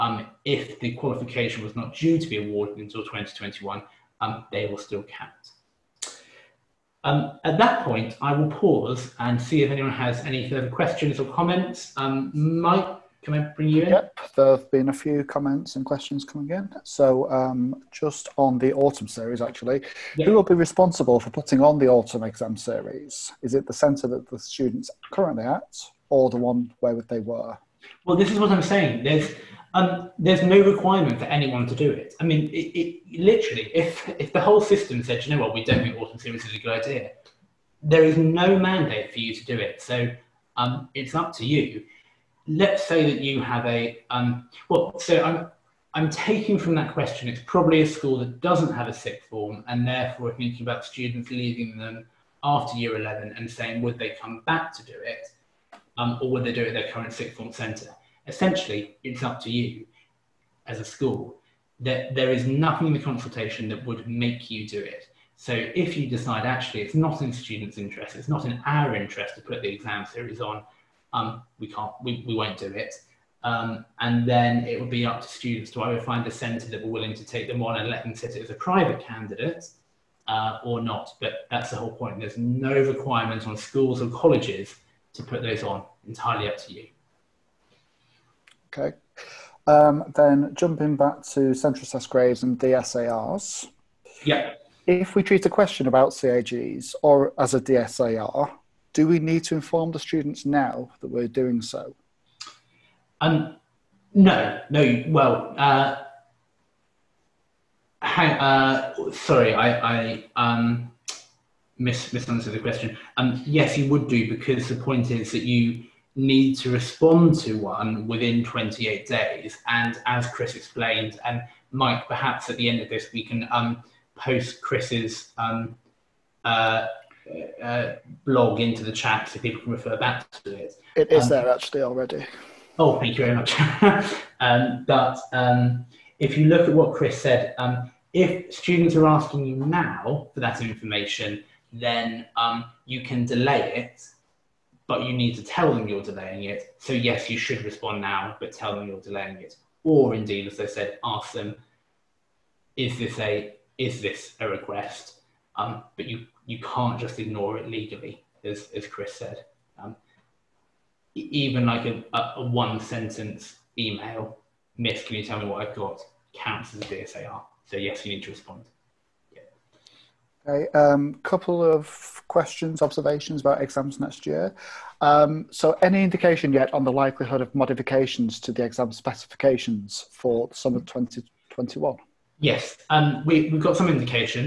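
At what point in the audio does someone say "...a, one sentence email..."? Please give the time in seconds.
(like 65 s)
162 s.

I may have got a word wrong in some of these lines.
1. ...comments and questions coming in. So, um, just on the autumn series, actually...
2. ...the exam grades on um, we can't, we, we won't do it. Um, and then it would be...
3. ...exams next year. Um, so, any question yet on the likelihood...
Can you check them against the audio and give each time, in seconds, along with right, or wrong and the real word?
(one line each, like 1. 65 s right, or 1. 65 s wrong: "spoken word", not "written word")
1. 15 s right
2. 69 s wrong: "series", not "grades"
3. 173 s wrong: "indication", not "question".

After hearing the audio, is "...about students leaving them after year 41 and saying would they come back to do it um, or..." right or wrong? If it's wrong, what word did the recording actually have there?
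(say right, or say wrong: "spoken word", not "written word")
wrong: "11", not "41".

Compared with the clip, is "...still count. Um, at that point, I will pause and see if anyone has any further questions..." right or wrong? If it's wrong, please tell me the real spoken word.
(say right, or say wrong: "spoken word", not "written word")
right.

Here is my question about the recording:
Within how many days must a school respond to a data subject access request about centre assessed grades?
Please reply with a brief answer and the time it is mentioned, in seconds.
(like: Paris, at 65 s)
28 days, at 118 s.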